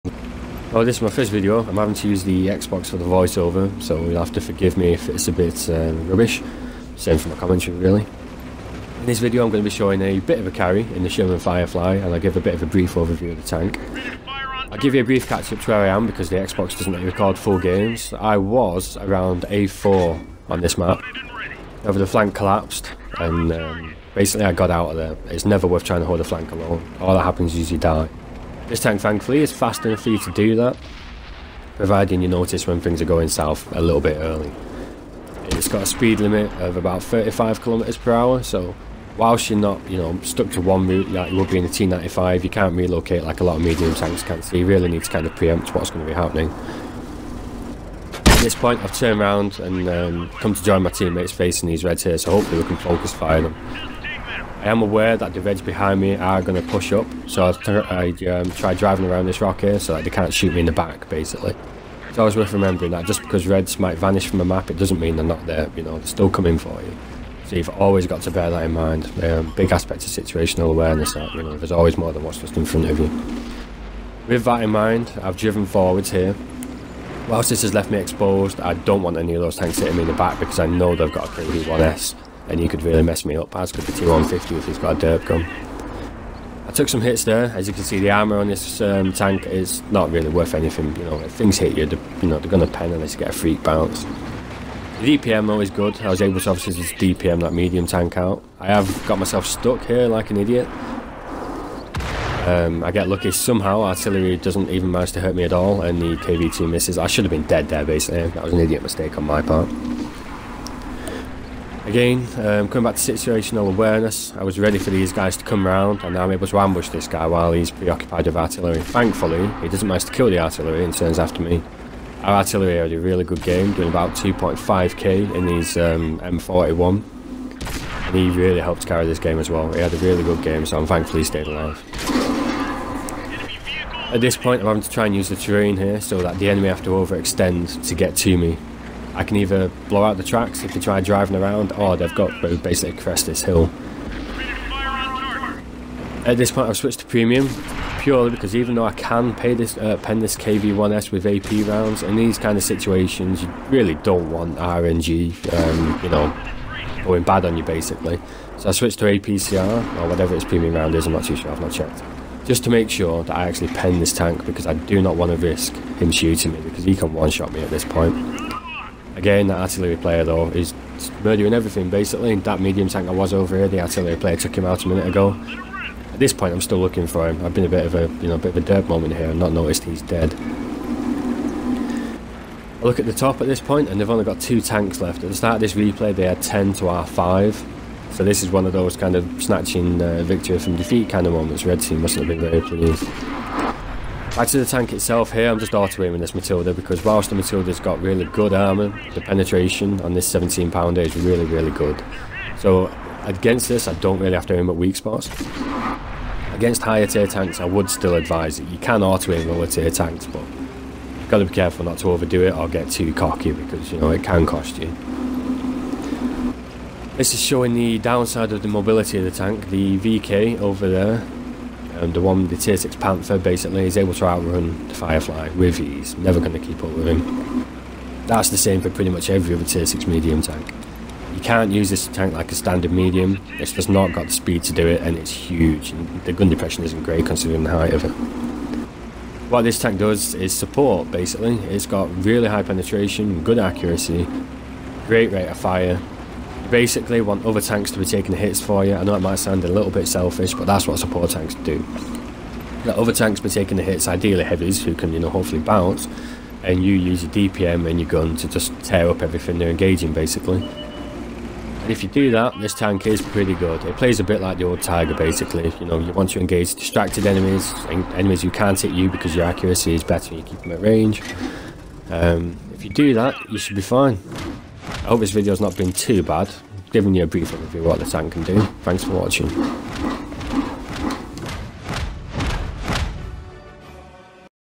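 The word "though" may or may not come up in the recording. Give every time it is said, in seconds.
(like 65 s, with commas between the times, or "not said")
95 s, 148 s, 170 s.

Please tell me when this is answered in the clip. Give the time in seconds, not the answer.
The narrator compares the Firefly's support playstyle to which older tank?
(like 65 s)
264 s.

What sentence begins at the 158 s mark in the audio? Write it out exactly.
So I switched to APCR, or whatever its premium round is, I'm not too sure, I've not checked.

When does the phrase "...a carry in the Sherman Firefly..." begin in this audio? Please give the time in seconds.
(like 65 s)
10 s.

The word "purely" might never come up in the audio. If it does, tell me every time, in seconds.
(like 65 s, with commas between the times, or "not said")
147 s.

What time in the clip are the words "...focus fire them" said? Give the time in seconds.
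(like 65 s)
52 s.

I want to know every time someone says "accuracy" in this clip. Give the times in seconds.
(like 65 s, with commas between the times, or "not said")
243 s, 269 s.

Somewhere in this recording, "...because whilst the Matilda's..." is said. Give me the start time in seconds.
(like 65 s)
196 s.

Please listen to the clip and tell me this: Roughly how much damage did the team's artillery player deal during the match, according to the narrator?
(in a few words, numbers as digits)
2.5k.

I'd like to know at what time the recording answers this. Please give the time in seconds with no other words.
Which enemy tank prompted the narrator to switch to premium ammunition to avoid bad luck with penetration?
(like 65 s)
150 s.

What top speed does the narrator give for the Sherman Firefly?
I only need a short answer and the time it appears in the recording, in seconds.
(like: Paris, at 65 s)
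35 km/h, at 37 s.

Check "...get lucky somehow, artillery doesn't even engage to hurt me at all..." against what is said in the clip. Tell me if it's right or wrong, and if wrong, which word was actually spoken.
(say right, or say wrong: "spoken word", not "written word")
wrong: "manage", not "engage".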